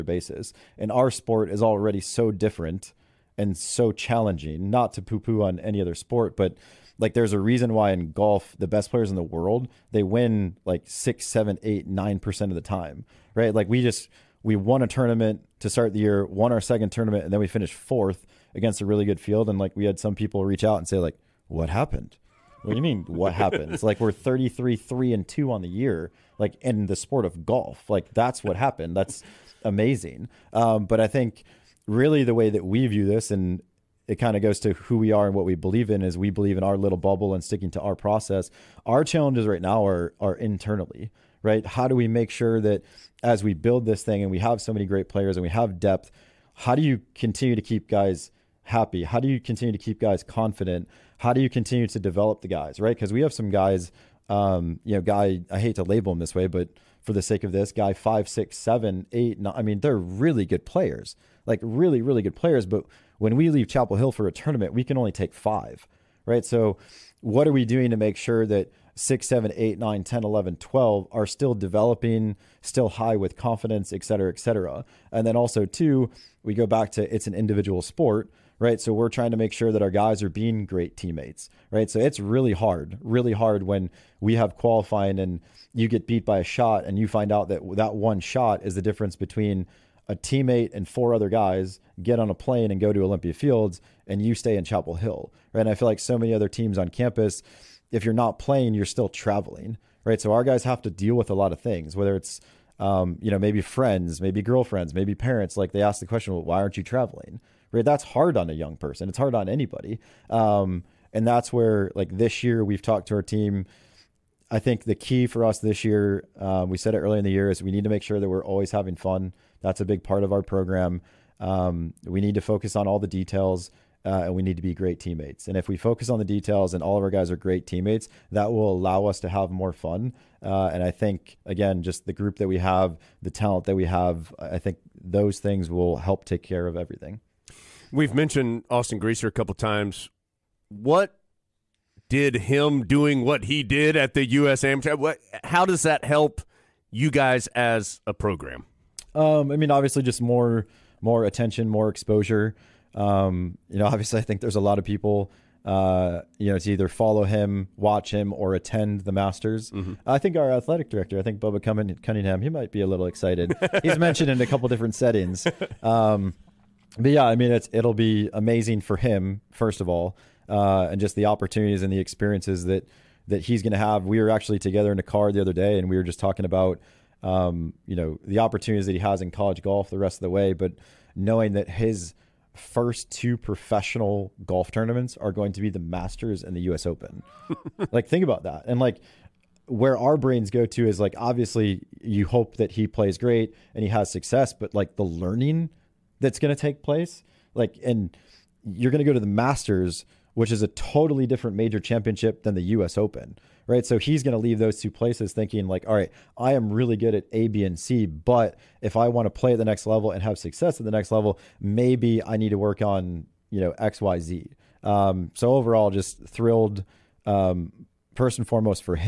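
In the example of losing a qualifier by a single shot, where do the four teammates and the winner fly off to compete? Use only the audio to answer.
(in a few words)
Olympia Fields.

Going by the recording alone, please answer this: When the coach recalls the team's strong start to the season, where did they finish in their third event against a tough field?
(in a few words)
4th.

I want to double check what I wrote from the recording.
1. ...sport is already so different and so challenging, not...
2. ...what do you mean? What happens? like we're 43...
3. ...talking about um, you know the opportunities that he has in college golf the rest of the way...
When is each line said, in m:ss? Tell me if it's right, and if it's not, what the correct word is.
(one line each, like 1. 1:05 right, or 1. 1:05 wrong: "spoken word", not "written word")
1. 0:01 right
2. 0:22 wrong: "33", not "43"
3. 2:56 right.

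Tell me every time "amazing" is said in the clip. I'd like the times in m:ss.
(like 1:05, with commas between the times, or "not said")
0:29, 2:48.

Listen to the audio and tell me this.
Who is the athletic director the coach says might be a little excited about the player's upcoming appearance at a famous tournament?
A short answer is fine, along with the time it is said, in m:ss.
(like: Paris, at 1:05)
Bubba Cunningham, at 2:41.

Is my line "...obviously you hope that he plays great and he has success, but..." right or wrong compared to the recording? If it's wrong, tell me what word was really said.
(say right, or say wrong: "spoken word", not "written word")
right.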